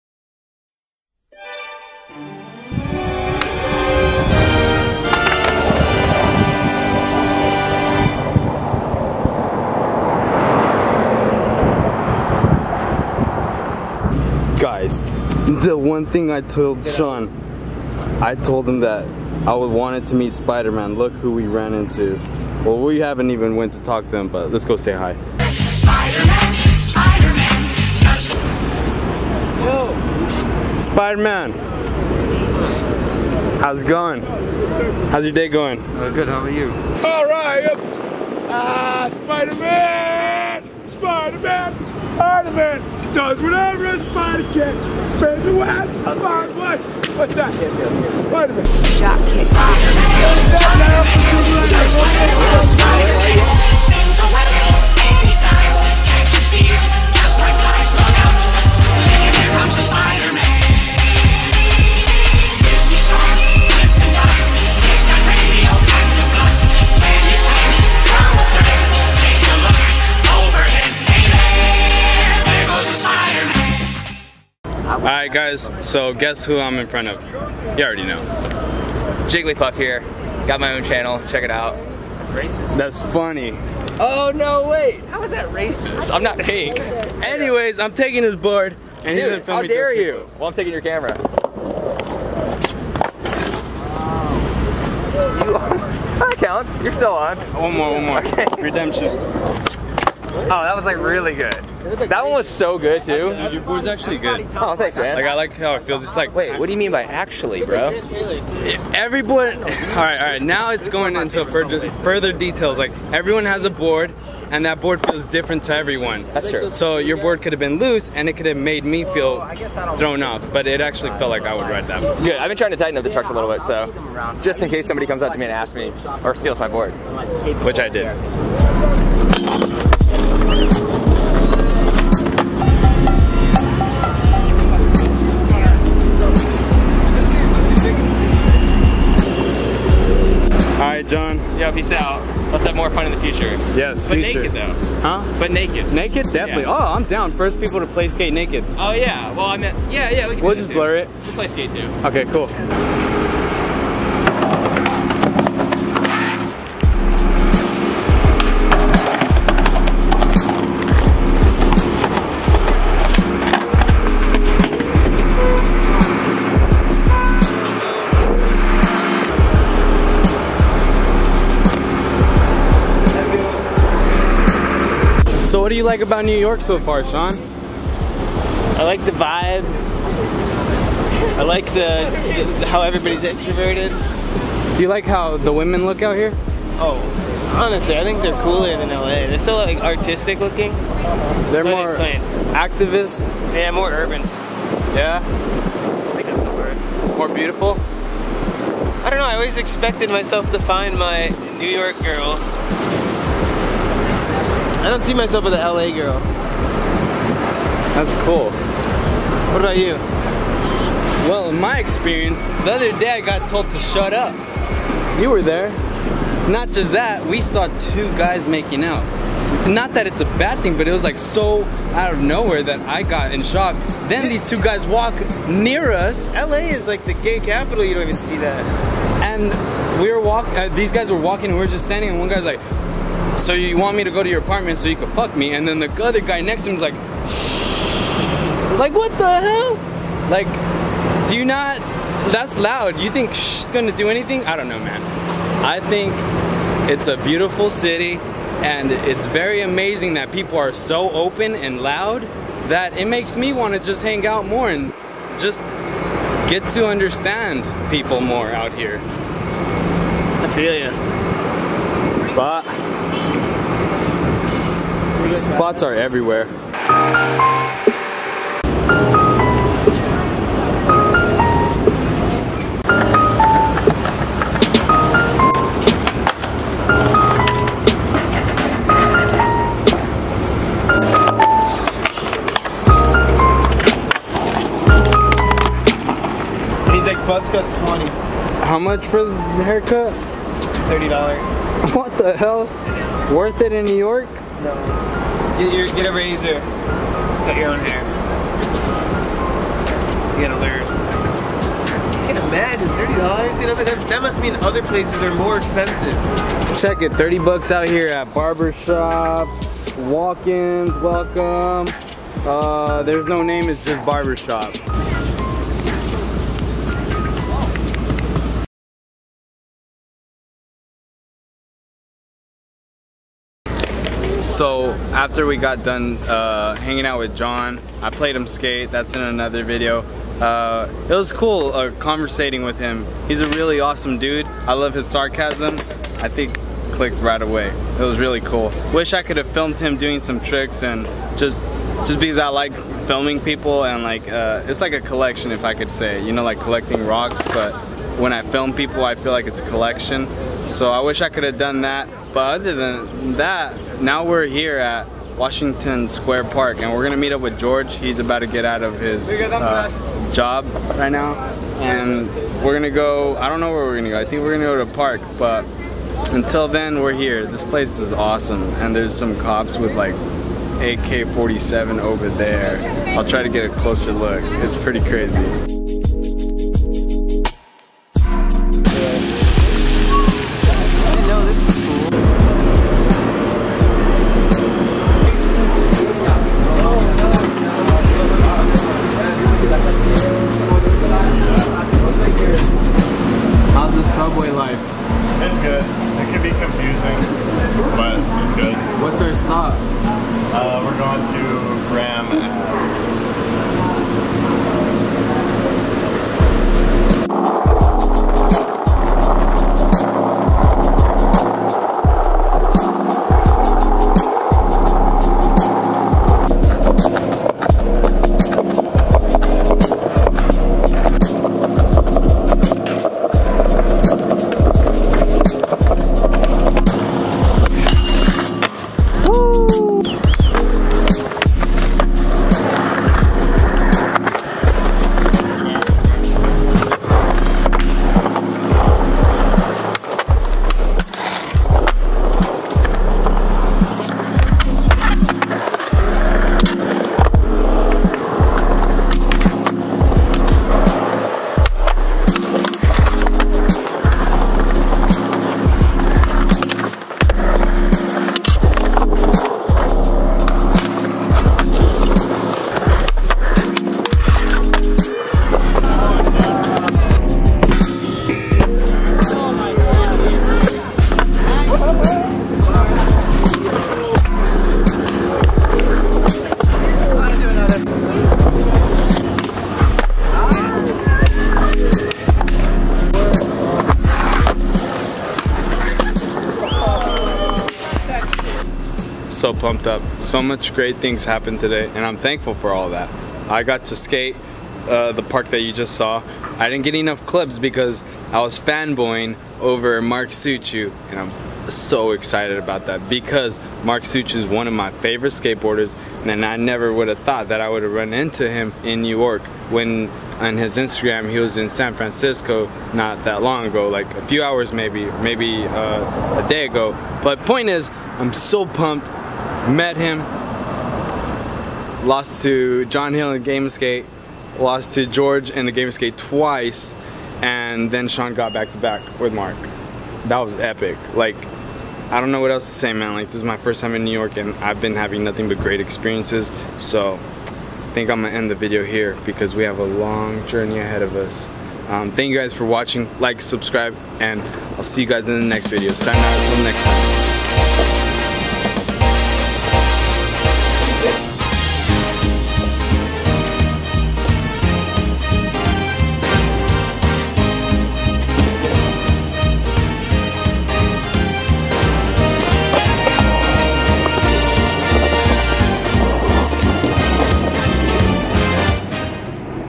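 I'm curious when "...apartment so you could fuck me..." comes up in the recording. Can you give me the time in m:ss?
3:54.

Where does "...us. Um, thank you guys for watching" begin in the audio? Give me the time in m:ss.
9:01.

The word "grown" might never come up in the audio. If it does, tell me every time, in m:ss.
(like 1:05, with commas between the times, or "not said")
not said.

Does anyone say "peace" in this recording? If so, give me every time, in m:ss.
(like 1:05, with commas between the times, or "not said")
2:21.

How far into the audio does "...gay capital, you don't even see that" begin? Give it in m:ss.
3:47.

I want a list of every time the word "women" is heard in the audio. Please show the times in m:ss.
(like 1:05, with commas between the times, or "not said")
3:05.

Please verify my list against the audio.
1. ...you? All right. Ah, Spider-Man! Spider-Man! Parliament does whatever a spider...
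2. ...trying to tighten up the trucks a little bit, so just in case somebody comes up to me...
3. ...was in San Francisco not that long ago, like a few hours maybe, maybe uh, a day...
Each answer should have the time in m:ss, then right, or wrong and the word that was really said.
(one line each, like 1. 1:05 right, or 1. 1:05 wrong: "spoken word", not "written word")
1. 0:36 right
2. 2:02 right
3. 8:31 right.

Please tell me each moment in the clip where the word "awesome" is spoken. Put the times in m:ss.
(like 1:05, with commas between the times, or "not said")
5:33, 6:08.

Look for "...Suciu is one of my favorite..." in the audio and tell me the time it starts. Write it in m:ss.
8:24.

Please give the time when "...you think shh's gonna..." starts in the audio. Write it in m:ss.
4:02.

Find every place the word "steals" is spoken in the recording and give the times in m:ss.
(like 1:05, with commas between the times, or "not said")
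2:06.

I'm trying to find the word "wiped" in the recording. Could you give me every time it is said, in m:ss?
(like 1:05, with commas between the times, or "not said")
not said.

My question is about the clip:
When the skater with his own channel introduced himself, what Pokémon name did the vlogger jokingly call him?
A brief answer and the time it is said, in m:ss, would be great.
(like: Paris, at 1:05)
Jigglypuff, at 1:19.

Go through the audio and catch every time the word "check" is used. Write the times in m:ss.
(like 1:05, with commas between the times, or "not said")
1:21, 5:06.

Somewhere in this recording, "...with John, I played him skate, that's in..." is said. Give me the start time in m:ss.
5:27.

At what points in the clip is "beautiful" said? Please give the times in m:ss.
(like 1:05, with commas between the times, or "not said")
3:17, 4:07.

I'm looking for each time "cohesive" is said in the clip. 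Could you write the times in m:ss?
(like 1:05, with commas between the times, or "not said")
not said.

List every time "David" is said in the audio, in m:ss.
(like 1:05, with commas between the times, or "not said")
not said.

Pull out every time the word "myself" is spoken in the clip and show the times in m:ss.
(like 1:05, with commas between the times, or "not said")
3:20, 3:25.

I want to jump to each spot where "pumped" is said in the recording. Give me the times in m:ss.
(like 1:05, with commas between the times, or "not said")
8:09, 8:38.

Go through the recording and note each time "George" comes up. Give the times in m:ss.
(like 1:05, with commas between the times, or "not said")
5:57, 8:45.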